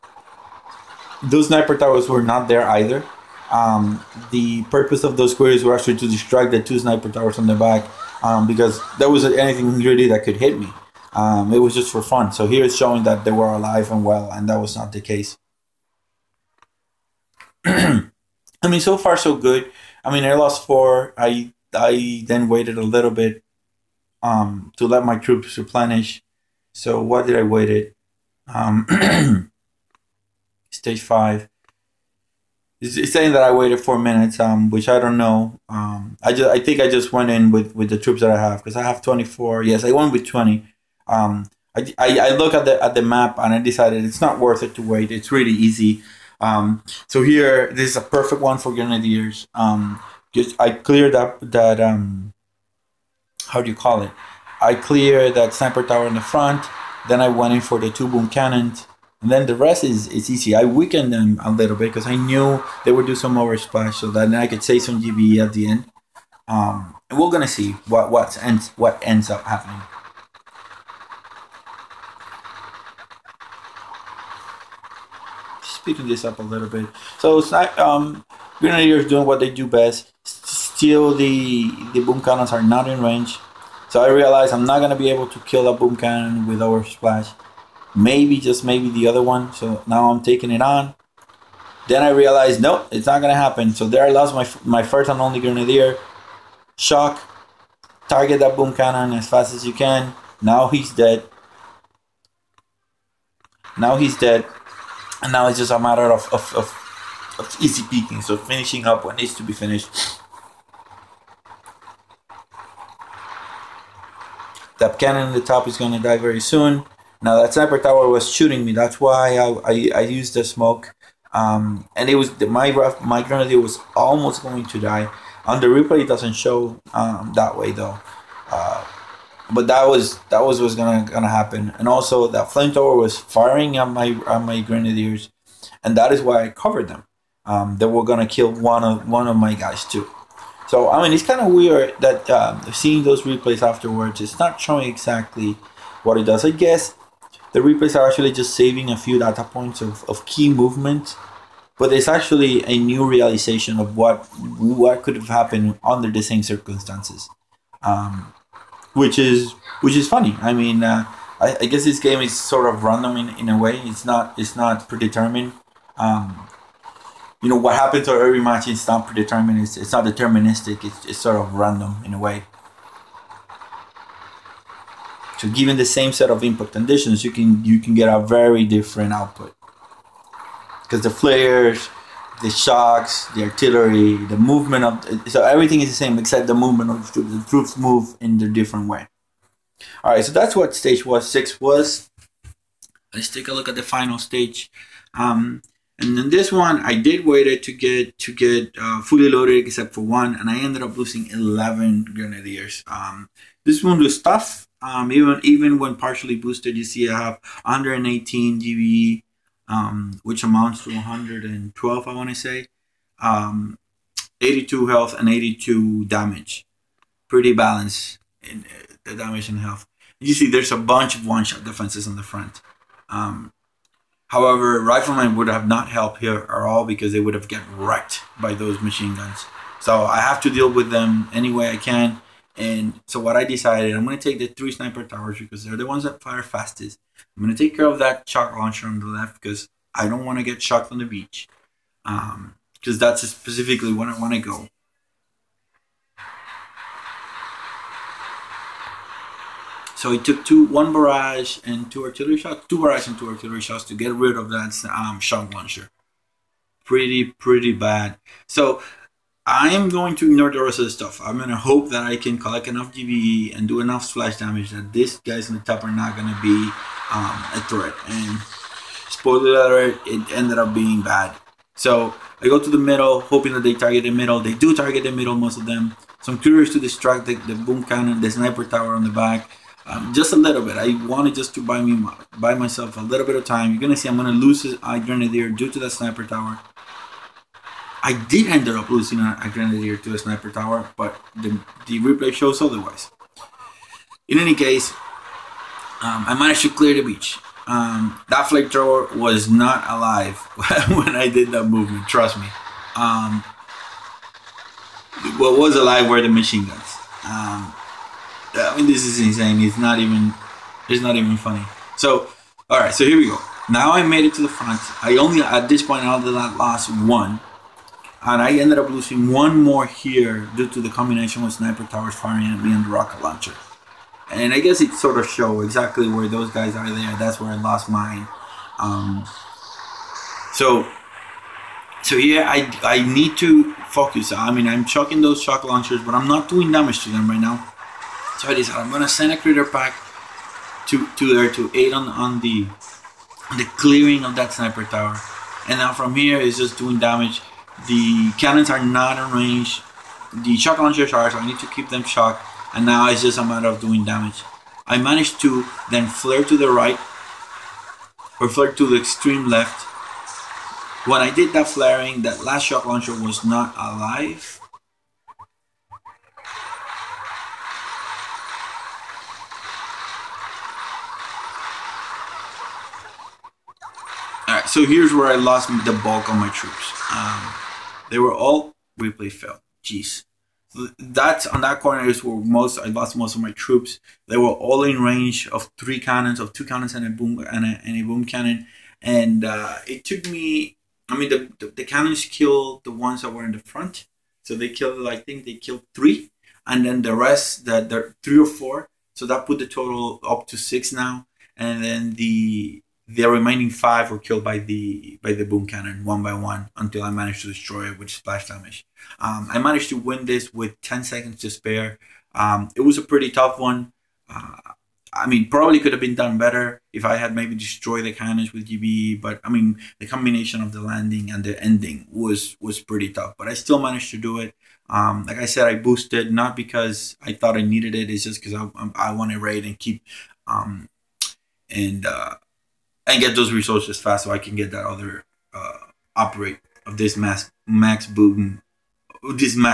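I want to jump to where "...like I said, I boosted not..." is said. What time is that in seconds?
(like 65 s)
425 s.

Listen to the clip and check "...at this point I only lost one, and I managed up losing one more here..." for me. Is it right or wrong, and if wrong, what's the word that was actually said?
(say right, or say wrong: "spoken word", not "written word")
wrong: "ended", not "managed".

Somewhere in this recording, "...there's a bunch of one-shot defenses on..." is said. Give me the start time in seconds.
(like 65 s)
220 s.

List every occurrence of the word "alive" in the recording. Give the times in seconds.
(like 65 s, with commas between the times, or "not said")
13 s, 299 s, 305 s, 363 s.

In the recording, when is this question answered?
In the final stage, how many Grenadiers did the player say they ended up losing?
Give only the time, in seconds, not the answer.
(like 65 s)
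201 s.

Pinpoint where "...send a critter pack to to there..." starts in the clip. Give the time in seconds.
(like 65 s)
339 s.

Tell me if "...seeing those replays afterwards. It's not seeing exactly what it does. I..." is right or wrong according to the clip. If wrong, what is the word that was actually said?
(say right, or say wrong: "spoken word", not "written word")
wrong: "showing", not "seeing".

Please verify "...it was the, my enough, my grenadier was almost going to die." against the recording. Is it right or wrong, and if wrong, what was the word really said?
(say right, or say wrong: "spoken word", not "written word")
wrong: "rough", not "enough".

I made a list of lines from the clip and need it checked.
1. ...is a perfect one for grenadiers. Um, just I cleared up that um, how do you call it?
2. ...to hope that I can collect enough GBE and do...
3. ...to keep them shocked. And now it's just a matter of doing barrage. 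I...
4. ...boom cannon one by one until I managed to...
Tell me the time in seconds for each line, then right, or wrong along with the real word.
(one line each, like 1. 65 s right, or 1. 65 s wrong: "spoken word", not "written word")
1. 47 s right
2. 261 s right
3. 351 s wrong: "damage", not "barrage"
4. 405 s right.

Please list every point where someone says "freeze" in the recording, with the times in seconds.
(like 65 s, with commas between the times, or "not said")
not said.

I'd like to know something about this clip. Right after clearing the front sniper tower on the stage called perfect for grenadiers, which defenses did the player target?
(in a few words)
two boom cannons.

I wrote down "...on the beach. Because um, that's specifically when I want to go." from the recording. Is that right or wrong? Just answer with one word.
right.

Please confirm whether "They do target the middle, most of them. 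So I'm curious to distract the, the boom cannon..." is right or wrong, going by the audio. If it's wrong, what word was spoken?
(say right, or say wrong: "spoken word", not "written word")
right.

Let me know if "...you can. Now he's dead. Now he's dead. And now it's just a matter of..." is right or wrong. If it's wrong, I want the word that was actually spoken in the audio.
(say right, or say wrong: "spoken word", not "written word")
right.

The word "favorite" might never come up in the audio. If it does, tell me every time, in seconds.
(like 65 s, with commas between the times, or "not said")
not said.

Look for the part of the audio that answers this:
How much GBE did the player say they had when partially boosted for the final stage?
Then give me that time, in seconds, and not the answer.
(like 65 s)
207 s.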